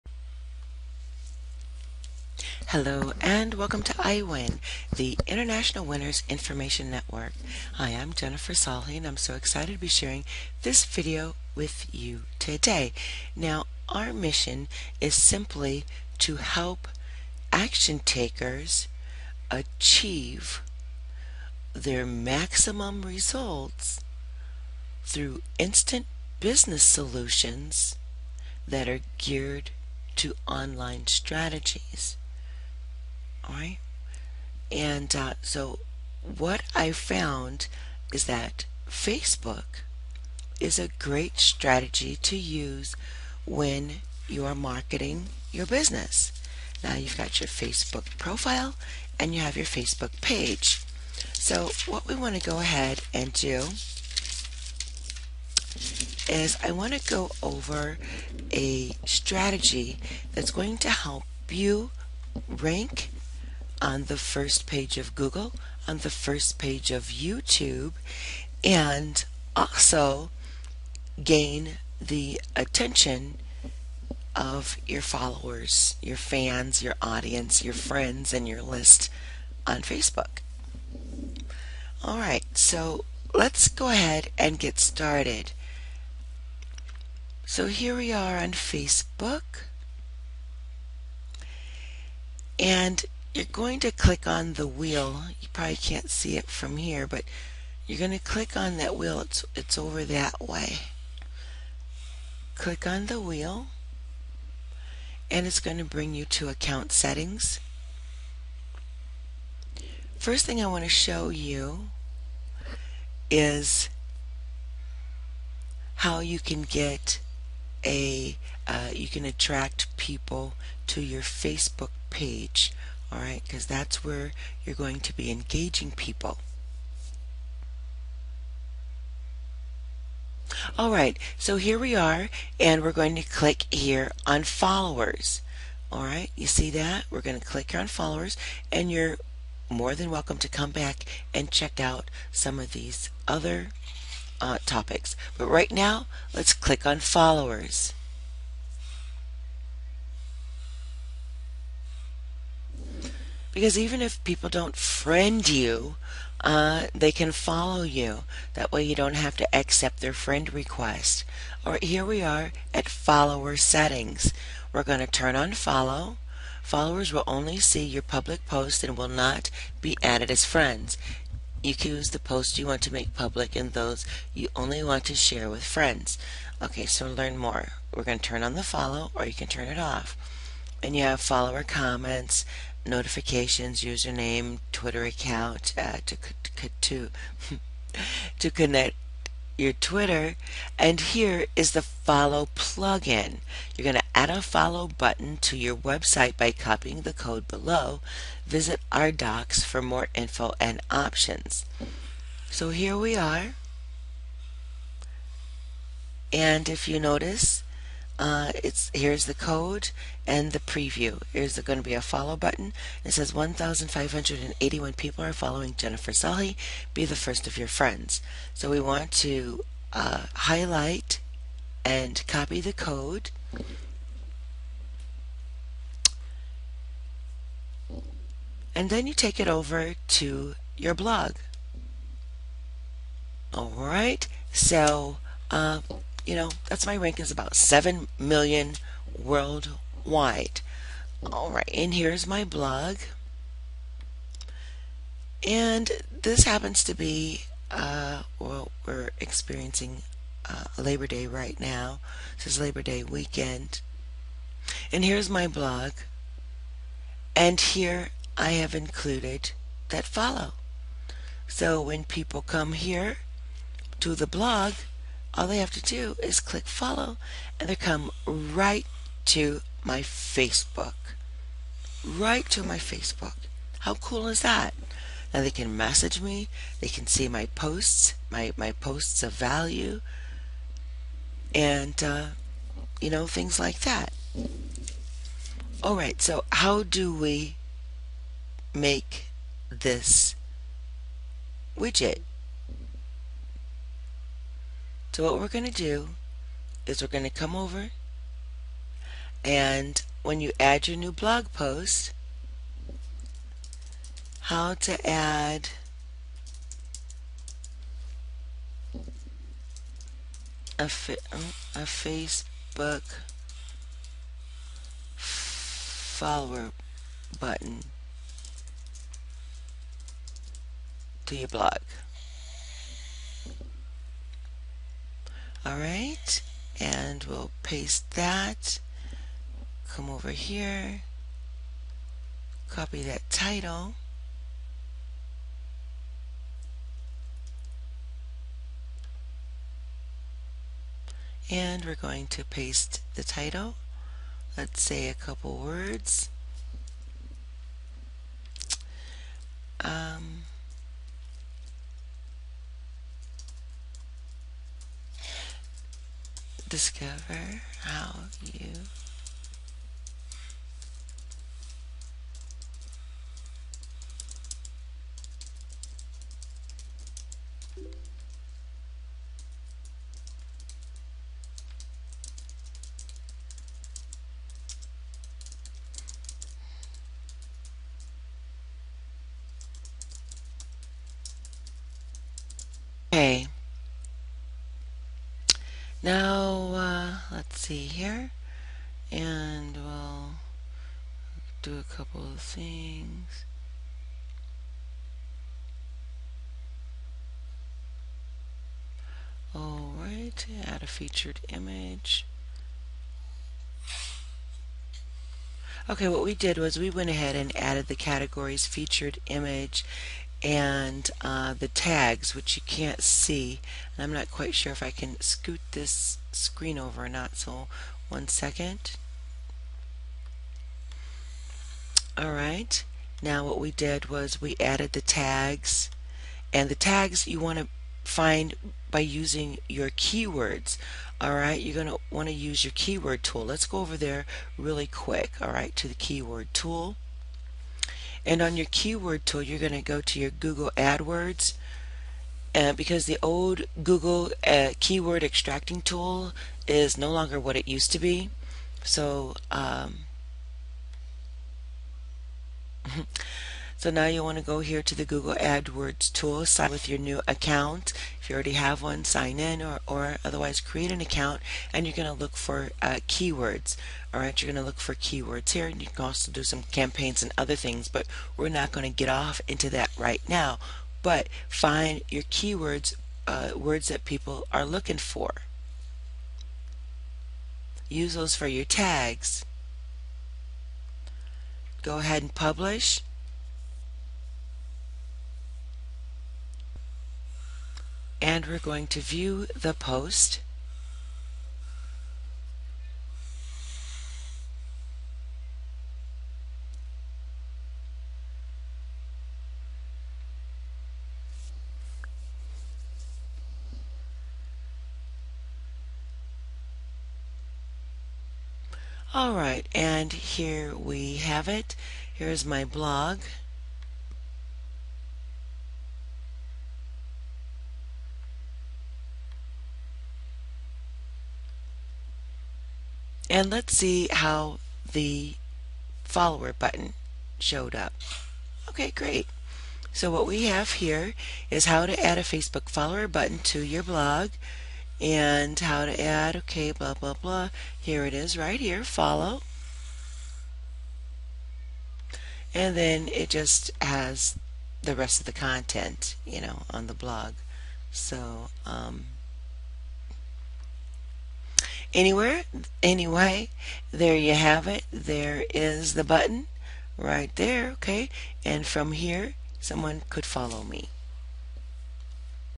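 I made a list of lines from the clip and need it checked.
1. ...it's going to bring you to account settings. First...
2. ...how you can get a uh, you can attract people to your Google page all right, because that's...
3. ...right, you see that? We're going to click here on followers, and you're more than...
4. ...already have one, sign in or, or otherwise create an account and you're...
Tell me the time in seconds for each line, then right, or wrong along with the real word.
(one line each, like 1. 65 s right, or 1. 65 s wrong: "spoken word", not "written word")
1. 105 s right
2. 115 s wrong: "Facebook", not "Google"
3. 136 s right
4. 458 s right.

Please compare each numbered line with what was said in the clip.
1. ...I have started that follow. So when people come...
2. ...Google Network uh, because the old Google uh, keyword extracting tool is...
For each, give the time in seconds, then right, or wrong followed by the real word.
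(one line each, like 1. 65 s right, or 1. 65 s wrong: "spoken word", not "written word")
1. 258 s wrong: "included", not "started"
2. 440 s wrong: "AdWords", not "Network".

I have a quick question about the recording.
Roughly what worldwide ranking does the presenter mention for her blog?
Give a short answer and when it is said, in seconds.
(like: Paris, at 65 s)
about 7 million, at 237 s.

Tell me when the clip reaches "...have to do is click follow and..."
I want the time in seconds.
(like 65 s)
265 s.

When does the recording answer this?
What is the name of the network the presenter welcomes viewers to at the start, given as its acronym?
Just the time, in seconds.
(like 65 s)
3 s.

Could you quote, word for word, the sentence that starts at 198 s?
Visit our docs for more info and options.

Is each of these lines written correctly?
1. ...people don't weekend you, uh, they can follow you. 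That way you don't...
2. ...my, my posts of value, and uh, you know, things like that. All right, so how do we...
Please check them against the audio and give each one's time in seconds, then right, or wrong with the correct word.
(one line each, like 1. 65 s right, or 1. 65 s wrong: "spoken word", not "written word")
1. 154 s wrong: "friend", not "weekend"
2. 278 s right.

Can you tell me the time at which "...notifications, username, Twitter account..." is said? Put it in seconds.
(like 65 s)
182 s.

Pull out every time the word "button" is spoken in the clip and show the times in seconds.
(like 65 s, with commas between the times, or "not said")
194 s, 212 s, 317 s, 526 s, 533 s, 556 s.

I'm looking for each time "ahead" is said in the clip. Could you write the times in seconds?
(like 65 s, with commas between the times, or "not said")
52 s, 83 s, 407 s, 481 s.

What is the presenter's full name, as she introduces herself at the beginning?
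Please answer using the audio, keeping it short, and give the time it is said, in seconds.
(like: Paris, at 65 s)
Jennifer Salhi, at 8 s.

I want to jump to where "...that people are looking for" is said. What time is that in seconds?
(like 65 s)
473 s.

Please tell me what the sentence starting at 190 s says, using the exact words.
And here is the follow plugin.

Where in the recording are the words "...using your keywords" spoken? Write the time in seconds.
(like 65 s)
428 s.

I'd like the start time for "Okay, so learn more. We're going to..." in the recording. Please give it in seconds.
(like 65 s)
176 s.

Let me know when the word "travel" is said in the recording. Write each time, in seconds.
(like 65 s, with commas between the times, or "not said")
not said.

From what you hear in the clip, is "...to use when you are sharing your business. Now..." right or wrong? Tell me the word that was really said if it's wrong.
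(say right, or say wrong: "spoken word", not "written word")
wrong: "marketing", not "sharing".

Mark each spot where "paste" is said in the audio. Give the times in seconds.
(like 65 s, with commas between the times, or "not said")
327 s, 342 s.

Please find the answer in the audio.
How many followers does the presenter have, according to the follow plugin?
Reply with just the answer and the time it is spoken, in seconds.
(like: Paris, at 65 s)
1,581, at 213 s.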